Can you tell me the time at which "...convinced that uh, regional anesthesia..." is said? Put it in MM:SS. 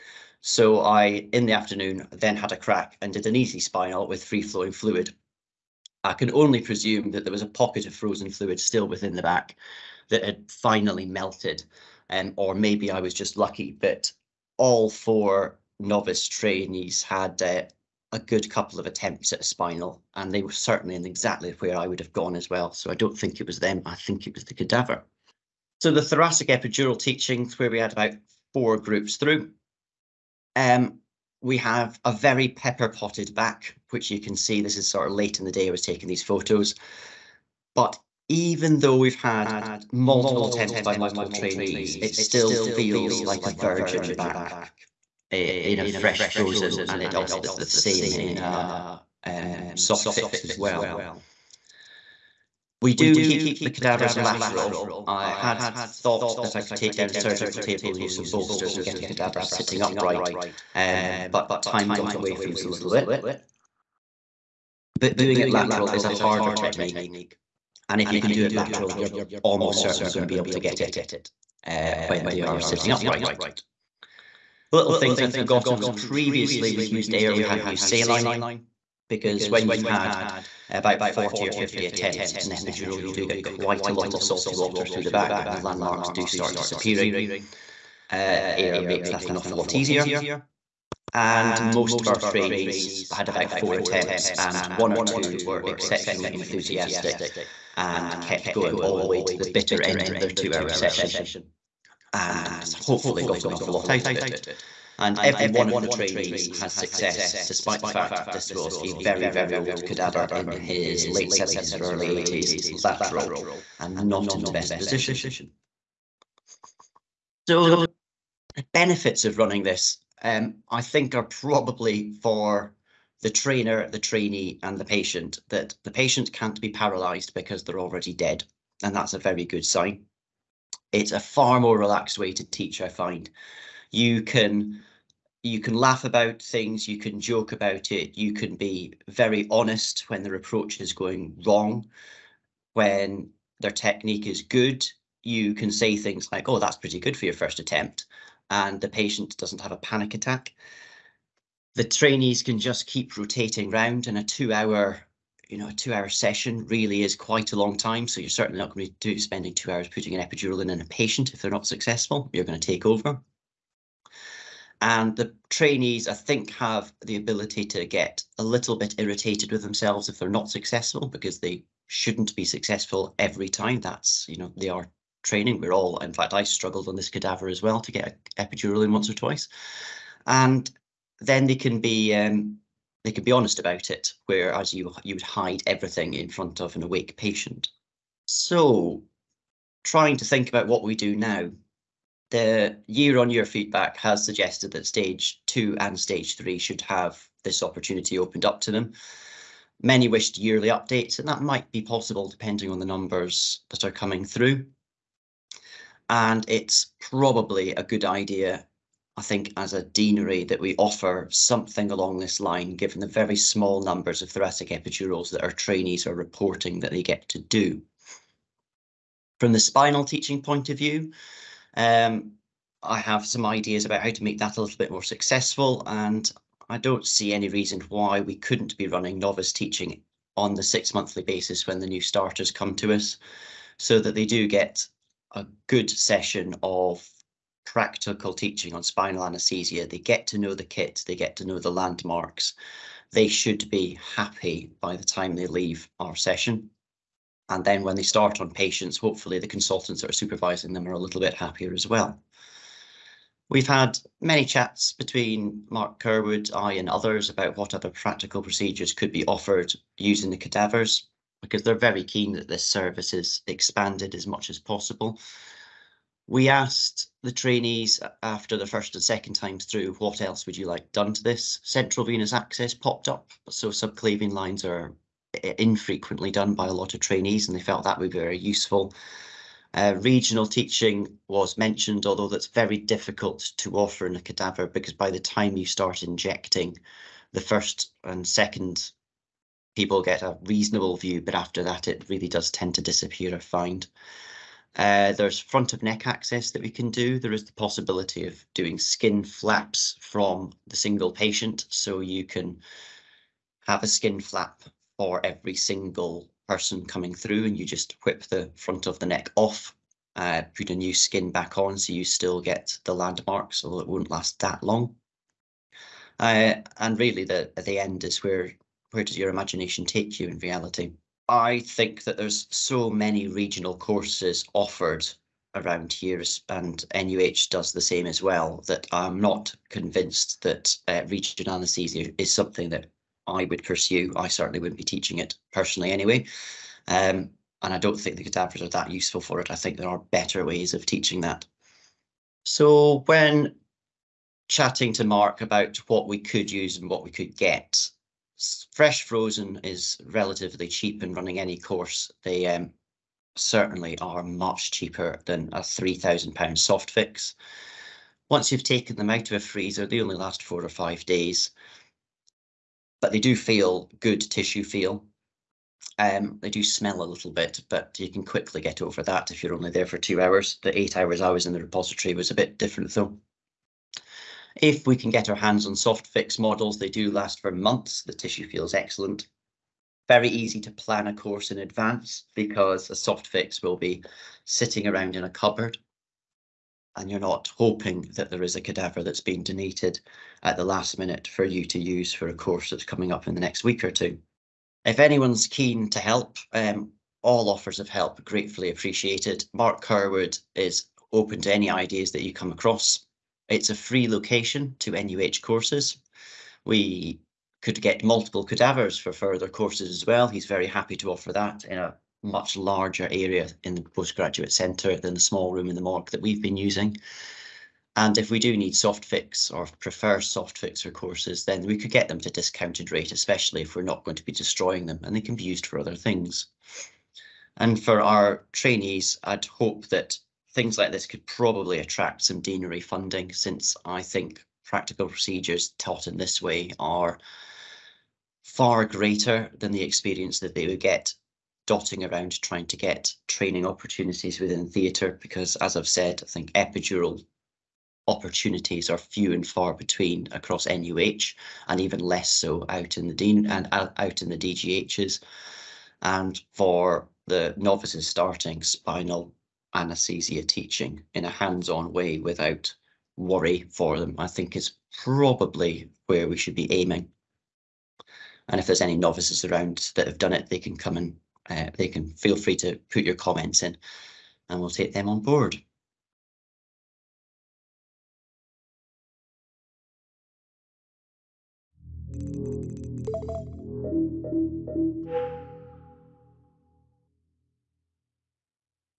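05:29.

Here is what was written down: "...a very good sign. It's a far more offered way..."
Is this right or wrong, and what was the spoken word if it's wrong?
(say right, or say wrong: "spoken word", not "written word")
wrong: "relaxed", not "offered".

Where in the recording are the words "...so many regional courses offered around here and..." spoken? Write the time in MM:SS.
05:22.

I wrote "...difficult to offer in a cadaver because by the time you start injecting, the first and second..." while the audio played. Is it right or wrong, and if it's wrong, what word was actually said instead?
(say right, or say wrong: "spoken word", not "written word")
right.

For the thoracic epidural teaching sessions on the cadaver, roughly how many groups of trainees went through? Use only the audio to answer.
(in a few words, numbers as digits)
4 groups.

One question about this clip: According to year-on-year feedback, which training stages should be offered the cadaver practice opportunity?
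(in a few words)
Stage 2 and stage 3.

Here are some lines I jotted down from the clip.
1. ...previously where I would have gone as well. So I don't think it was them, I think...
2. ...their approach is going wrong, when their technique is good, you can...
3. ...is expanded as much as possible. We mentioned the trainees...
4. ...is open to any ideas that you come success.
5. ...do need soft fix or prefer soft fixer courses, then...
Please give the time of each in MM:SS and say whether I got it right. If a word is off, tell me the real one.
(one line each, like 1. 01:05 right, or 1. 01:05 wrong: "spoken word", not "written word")
1. 00:21 wrong: "exactly", not "previously"
2. 02:20 right
3. 04:23 wrong: "asked", not "mentioned"
4. 06:40 wrong: "across", not "success"
5. 06:58 right.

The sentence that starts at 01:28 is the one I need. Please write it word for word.
Uh, air makes that an awful lot easier.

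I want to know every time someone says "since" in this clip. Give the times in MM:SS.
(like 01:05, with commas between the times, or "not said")
07:13.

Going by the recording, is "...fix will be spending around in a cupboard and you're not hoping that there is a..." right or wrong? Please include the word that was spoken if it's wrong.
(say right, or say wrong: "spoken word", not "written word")
wrong: "sitting", not "spending".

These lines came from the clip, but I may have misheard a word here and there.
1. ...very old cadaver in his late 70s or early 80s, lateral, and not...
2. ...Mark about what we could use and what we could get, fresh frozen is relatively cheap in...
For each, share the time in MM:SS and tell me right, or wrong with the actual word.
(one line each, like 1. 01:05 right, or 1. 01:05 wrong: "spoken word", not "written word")
1. 01:49 right
2. 05:45 right.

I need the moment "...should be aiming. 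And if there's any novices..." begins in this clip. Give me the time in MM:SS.
07:46.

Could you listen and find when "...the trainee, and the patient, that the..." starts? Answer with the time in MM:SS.
02:03.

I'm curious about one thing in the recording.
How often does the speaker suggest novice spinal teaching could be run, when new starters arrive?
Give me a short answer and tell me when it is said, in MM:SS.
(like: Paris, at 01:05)
6 monthly, at 03:50.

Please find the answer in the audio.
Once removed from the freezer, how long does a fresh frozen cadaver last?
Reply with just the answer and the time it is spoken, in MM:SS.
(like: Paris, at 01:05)
4 or 5 days, at 06:00.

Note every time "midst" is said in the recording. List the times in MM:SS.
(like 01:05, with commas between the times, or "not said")
not said.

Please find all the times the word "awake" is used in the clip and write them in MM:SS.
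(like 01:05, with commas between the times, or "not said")
03:06.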